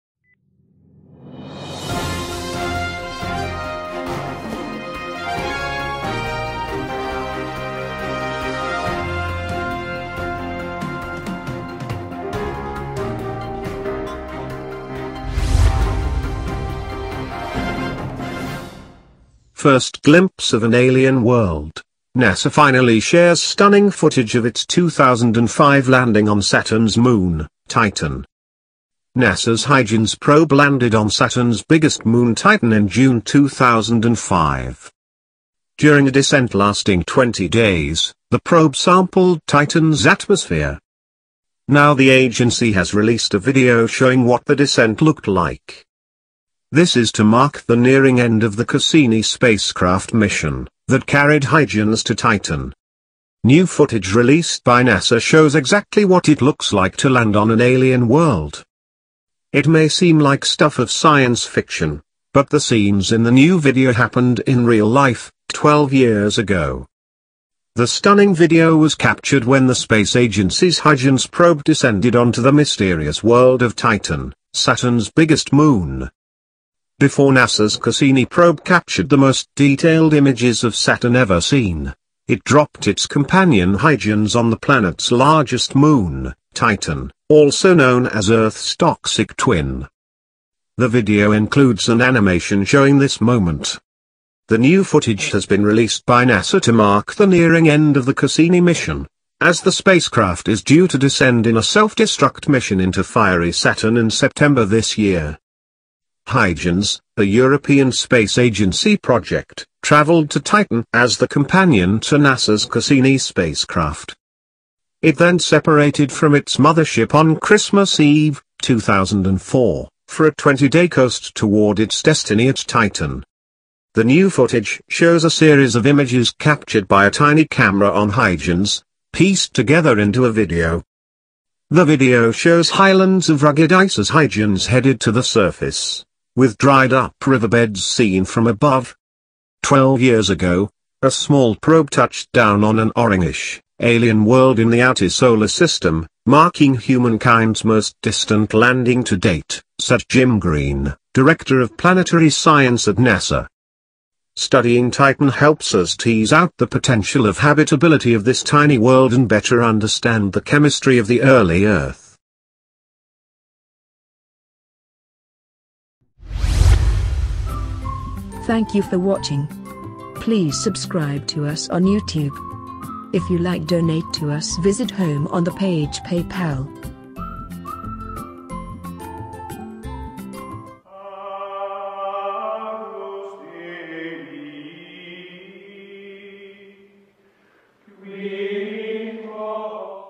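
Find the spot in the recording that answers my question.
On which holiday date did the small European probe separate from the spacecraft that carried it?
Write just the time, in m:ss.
1:57.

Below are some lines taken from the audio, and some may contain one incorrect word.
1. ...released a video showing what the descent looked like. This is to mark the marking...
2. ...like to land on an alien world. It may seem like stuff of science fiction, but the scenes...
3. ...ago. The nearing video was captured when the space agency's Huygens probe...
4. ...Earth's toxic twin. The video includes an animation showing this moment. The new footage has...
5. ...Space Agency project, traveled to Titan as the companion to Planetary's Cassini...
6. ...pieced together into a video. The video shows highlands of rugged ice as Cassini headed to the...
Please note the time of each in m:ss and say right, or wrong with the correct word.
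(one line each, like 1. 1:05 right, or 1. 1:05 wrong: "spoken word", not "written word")
1. 0:42 wrong: "nearing", not "marking"
2. 0:56 right
3. 1:06 wrong: "stunning", not "nearing"
4. 1:28 right
5. 1:47 wrong: "NASA", not "Planetary"
6. 2:09 wrong: "Huygens", not "Cassini".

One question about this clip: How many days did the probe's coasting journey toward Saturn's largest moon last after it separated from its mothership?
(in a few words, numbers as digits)
20.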